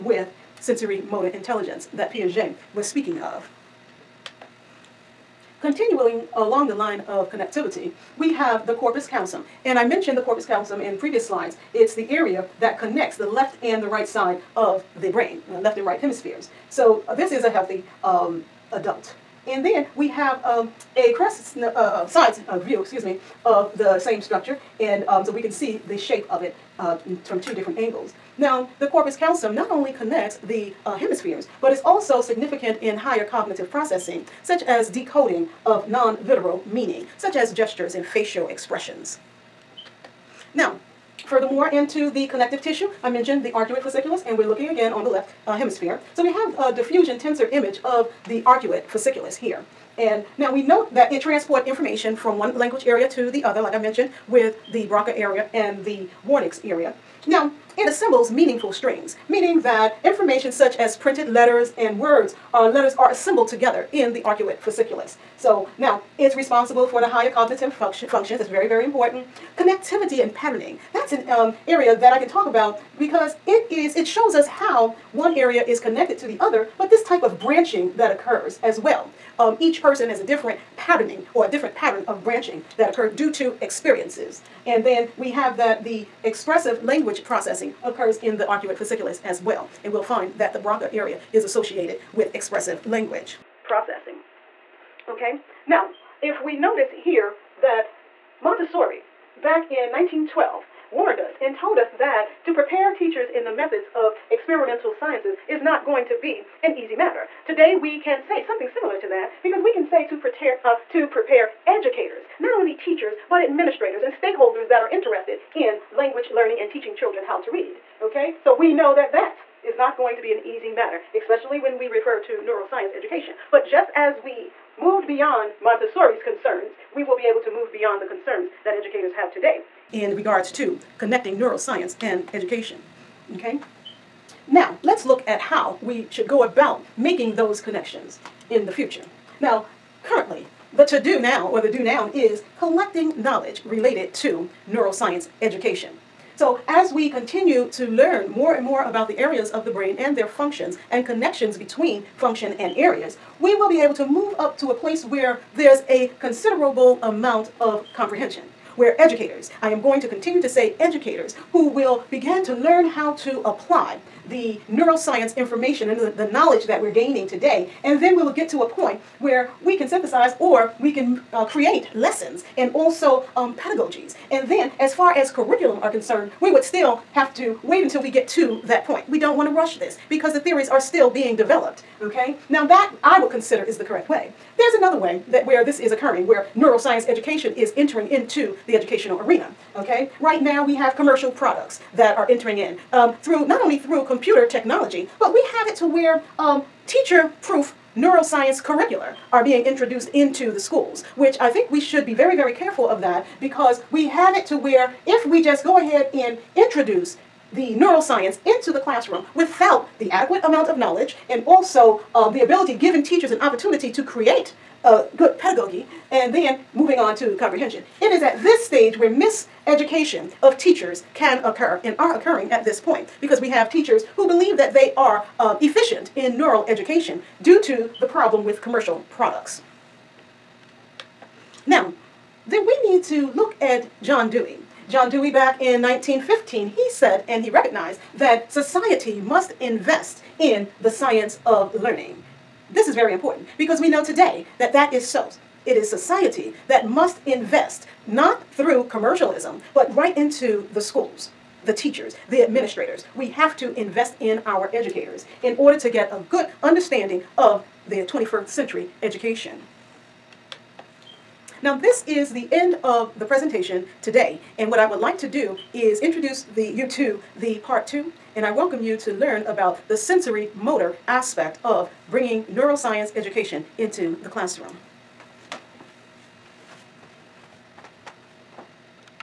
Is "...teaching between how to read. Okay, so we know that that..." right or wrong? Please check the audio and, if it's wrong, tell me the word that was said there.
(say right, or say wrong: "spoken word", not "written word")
wrong: "children", not "between".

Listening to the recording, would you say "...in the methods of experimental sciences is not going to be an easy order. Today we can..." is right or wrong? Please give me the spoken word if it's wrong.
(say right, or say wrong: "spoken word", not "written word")
wrong: "matter", not "order".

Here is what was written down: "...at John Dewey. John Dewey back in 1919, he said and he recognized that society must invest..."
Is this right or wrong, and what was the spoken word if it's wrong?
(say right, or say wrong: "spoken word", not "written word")
wrong: "1915", not "1919".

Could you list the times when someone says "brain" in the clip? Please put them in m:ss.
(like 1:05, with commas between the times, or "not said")
0:15, 2:29.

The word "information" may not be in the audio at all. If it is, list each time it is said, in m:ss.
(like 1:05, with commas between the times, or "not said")
0:51, 1:00, 2:45.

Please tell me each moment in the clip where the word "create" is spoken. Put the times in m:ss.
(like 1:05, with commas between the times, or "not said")
2:51, 3:34.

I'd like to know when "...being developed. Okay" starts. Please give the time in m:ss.
3:01.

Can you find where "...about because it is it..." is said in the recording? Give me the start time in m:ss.
1:12.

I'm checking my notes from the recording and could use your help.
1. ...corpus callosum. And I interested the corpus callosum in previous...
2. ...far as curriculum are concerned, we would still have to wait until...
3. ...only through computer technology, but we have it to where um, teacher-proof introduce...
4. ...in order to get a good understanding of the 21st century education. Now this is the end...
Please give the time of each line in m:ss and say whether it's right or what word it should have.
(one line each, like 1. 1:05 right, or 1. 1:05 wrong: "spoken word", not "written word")
1. 0:08 wrong: "mentioned", not "interested"
2. 2:54 right
3. 3:13 wrong: "neuroscience", not "introduce"
4. 4:15 right.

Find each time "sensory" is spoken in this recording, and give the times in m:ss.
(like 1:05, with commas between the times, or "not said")
0:00, 4:29.